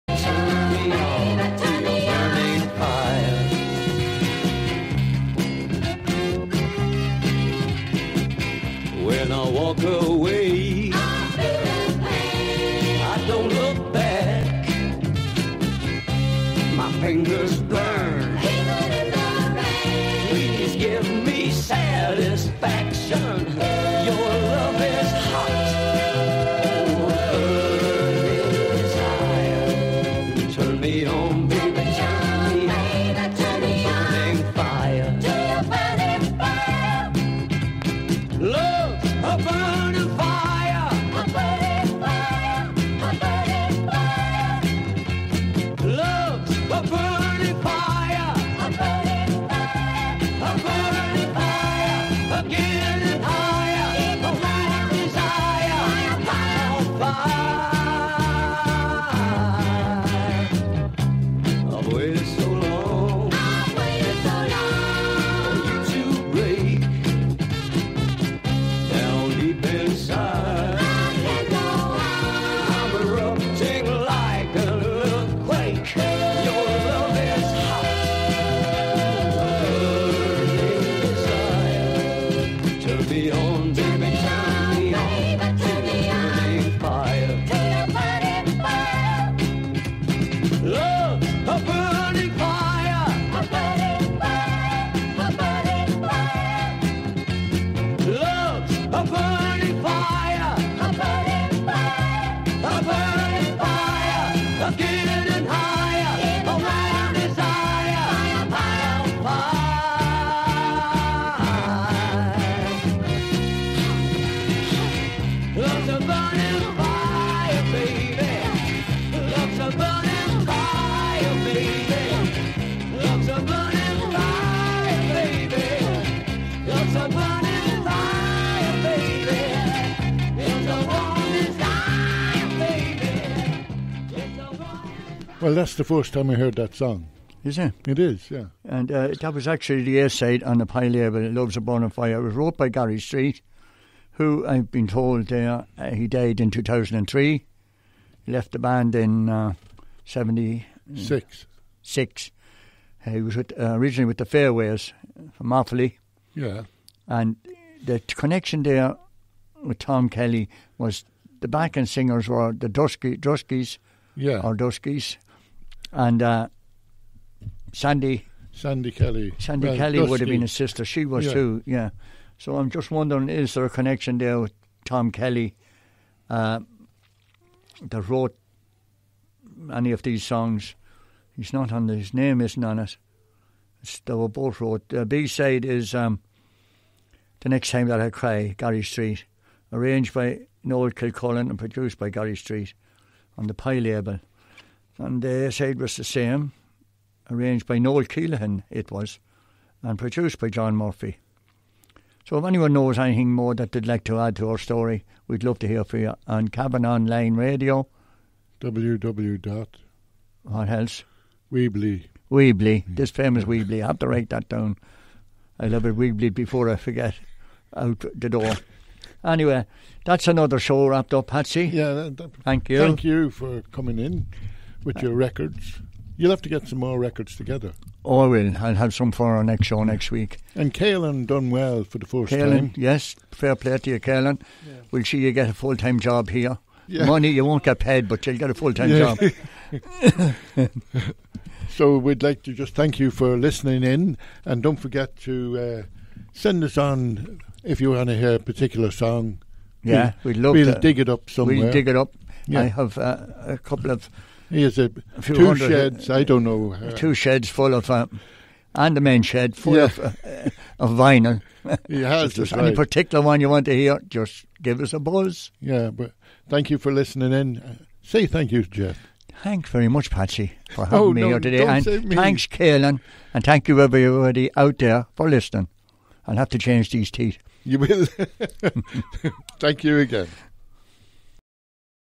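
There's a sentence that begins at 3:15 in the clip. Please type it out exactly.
And uh, the side was the same, arranged by Noel Keelahan, it was, and produced by John Murphy.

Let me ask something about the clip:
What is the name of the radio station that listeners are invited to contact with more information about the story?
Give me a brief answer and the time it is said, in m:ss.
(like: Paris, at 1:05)
Cavan Online Radio, at 3:26.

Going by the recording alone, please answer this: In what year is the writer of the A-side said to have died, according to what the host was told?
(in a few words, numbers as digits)
2003.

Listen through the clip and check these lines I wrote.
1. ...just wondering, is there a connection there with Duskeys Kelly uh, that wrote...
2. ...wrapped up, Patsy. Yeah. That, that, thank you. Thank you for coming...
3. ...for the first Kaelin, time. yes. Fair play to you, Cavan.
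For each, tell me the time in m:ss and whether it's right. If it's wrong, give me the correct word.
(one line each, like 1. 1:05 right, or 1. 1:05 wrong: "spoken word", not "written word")
1. 2:52 wrong: "Tom", not "Duskeys"
2. 3:40 right
3. 3:51 wrong: "Kaelin", not "Cavan".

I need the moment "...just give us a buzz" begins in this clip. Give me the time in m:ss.
4:24.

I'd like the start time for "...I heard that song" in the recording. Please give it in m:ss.
2:16.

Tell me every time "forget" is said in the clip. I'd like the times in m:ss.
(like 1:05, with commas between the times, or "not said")
3:36, 4:04.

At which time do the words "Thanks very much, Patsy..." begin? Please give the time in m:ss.
4:29.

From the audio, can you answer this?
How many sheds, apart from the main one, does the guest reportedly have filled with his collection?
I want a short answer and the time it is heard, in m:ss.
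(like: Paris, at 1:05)
2, at 4:16.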